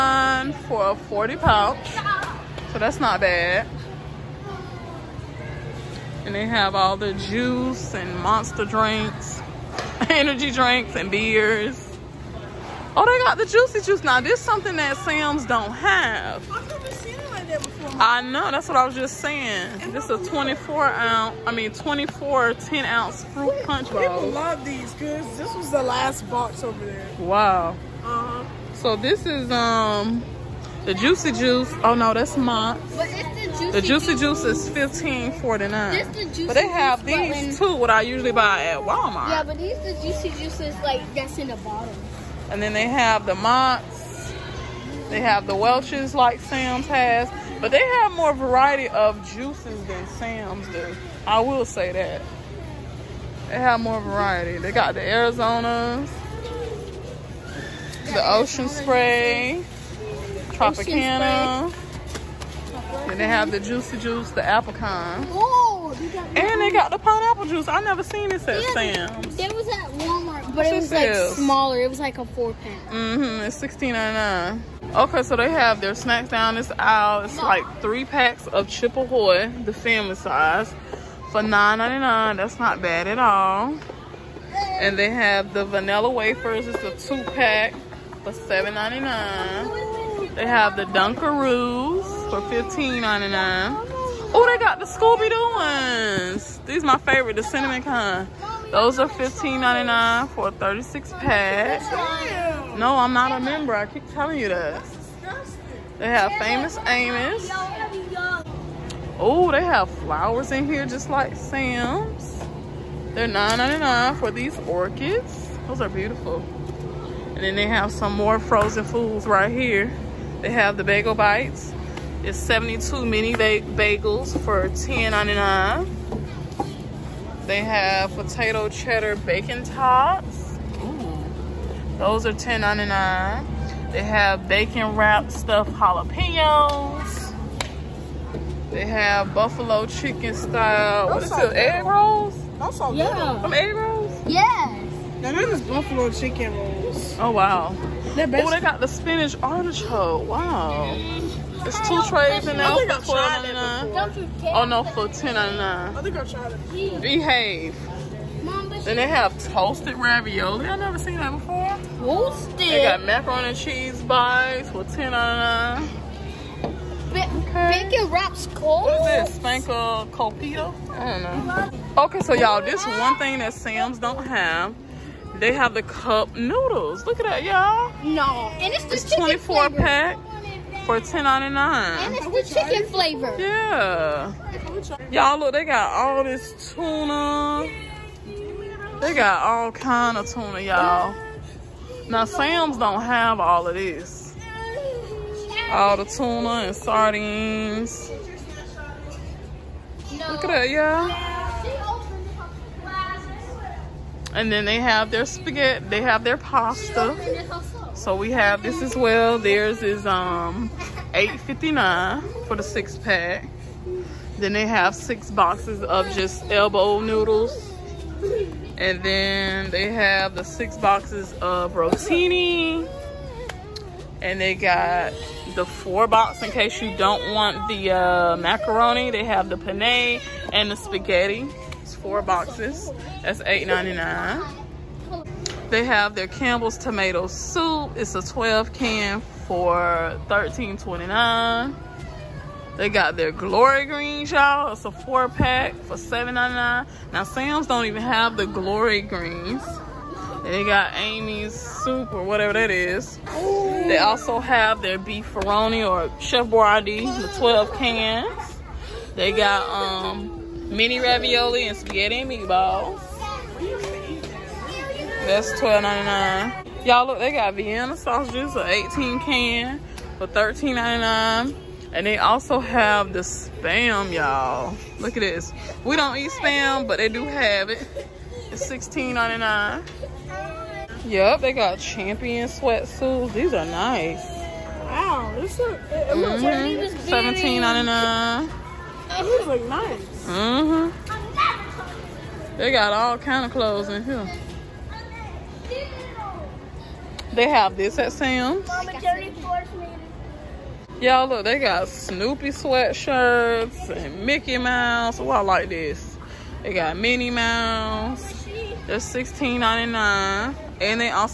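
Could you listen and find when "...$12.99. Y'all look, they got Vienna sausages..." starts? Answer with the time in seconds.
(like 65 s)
265 s.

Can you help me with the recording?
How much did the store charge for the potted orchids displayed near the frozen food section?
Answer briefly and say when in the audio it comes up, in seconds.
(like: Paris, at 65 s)
$9.99, at 113 s.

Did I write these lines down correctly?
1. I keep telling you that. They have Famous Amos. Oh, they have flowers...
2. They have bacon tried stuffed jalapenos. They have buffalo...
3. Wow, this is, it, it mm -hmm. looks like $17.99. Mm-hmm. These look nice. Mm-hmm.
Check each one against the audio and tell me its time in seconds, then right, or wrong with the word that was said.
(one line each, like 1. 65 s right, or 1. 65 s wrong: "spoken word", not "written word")
1. 103 s right
2. 133 s wrong: "wrapped", not "tried"
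3. 284 s right.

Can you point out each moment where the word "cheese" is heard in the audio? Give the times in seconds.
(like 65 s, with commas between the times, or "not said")
163 s.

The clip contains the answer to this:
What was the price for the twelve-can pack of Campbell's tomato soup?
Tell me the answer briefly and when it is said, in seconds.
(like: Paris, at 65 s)
$13.29, at 237 s.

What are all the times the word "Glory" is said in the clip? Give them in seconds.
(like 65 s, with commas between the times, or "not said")
243 s, 248 s.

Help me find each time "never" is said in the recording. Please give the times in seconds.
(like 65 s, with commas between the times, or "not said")
16 s, 67 s, 160 s.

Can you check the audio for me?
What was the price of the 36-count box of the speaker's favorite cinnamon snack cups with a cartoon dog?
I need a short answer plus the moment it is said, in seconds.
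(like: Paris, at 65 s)
$15.99, at 98 s.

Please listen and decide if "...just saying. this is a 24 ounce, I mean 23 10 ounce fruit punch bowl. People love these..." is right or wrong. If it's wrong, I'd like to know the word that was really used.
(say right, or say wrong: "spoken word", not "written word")
wrong: "24", not "23".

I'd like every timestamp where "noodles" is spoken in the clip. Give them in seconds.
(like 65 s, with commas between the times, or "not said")
176 s, 216 s.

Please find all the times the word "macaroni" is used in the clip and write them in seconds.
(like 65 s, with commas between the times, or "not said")
163 s, 228 s.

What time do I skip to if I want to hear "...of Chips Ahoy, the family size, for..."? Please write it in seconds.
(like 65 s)
78 s.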